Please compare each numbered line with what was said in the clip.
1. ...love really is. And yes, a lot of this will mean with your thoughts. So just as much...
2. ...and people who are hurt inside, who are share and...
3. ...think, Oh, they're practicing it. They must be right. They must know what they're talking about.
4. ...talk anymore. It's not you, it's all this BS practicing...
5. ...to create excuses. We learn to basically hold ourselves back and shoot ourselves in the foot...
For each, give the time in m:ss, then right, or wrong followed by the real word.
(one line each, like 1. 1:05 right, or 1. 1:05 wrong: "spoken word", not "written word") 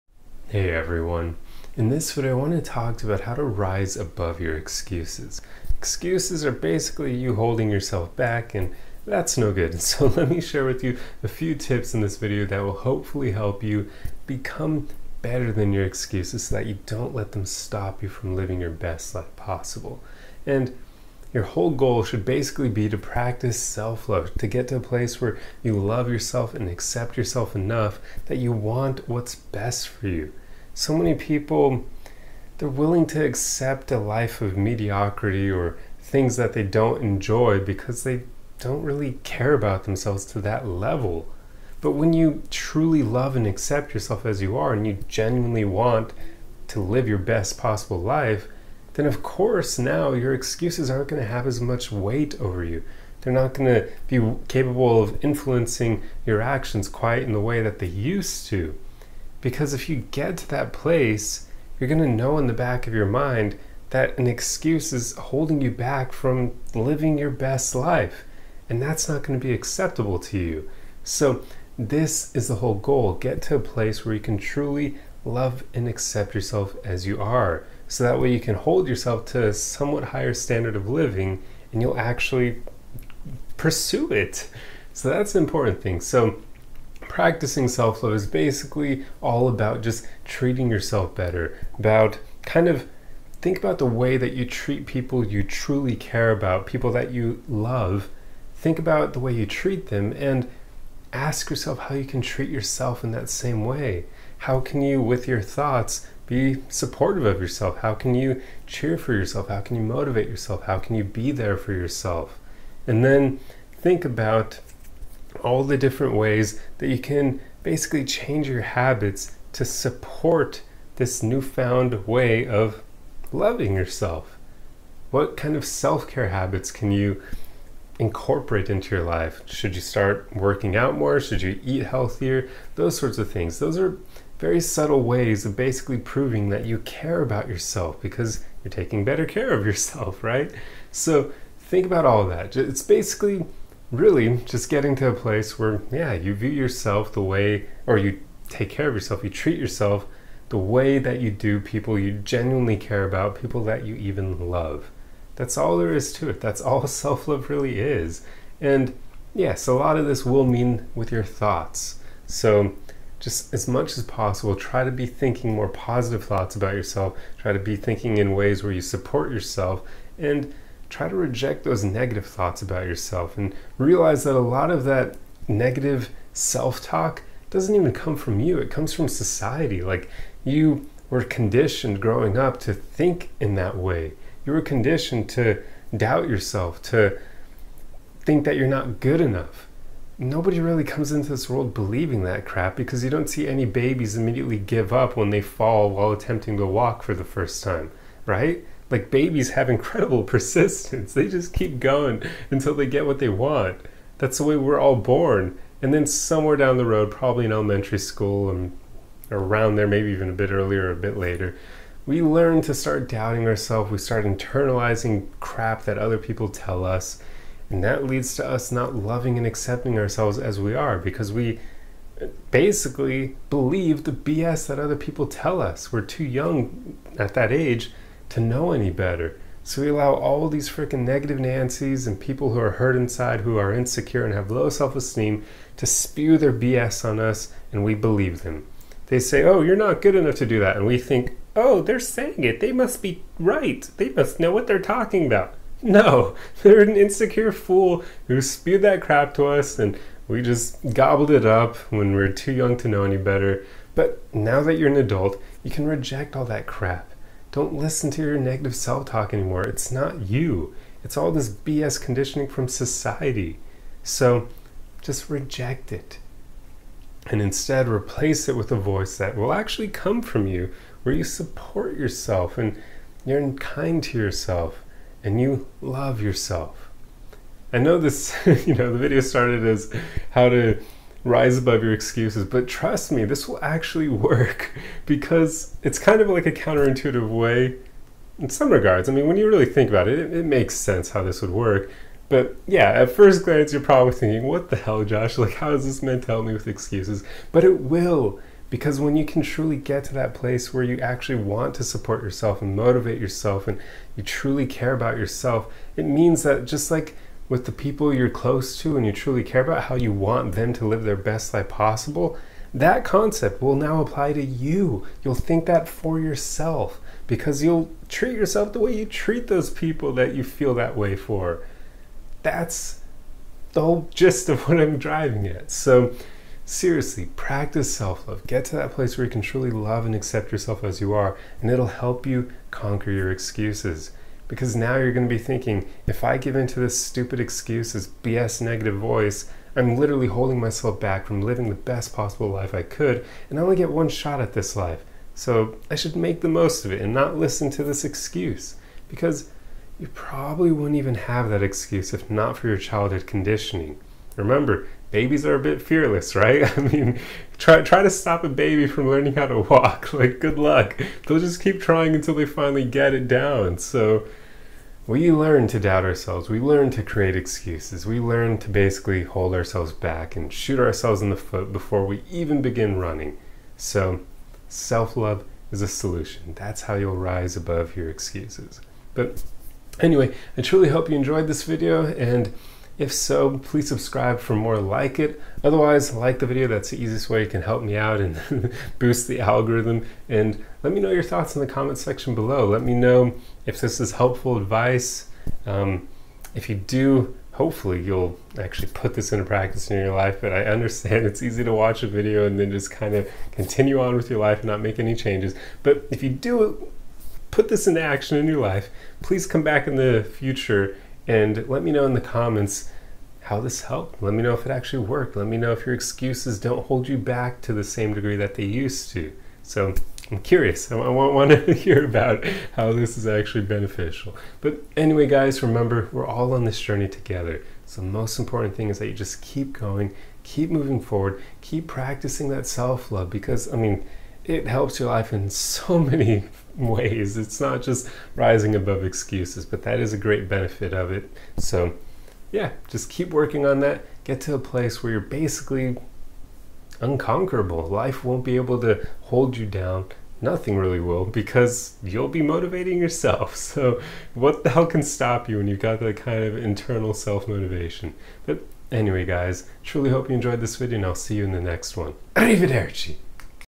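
1. 2:37 right
2. 3:52 wrong: "insecure", not "share"
3. 4:00 wrong: "saying", not "practicing"
4. 4:19 wrong: "conditioning", not "practicing"
5. 6:06 right.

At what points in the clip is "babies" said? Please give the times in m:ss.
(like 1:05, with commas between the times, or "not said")
3:13, 3:19, 5:55.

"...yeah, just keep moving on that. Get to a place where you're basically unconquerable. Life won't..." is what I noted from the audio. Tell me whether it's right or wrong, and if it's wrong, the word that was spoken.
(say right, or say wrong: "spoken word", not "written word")
wrong: "working", not "moving".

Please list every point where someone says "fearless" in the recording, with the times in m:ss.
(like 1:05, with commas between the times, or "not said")
5:55.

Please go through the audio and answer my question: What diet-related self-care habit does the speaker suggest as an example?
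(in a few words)
Eat healthier.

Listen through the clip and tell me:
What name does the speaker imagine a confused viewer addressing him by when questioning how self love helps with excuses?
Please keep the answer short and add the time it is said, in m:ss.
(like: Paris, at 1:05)
Josh, at 4:55.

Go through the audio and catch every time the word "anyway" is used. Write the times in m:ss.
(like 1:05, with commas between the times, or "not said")
6:19, 7:04, 7:38.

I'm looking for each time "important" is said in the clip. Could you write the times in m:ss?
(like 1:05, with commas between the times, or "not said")
1:25, 7:08.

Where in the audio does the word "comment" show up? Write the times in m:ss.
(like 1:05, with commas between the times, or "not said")
6:31, 6:52.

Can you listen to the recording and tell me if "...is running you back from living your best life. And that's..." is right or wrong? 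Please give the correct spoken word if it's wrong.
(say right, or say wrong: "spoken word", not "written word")
wrong: "holding", not "running".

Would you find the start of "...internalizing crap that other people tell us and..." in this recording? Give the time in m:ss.
3:34.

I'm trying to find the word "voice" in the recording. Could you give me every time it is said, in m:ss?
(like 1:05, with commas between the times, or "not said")
4:28, 5:38.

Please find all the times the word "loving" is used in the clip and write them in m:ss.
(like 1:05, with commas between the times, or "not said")
2:03, 3:38.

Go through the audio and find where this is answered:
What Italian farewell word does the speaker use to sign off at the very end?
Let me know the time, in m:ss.
7:42.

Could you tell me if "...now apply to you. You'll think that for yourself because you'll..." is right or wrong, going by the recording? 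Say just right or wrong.
right.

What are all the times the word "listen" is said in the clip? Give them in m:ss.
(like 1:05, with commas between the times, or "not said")
4:17, 5:47.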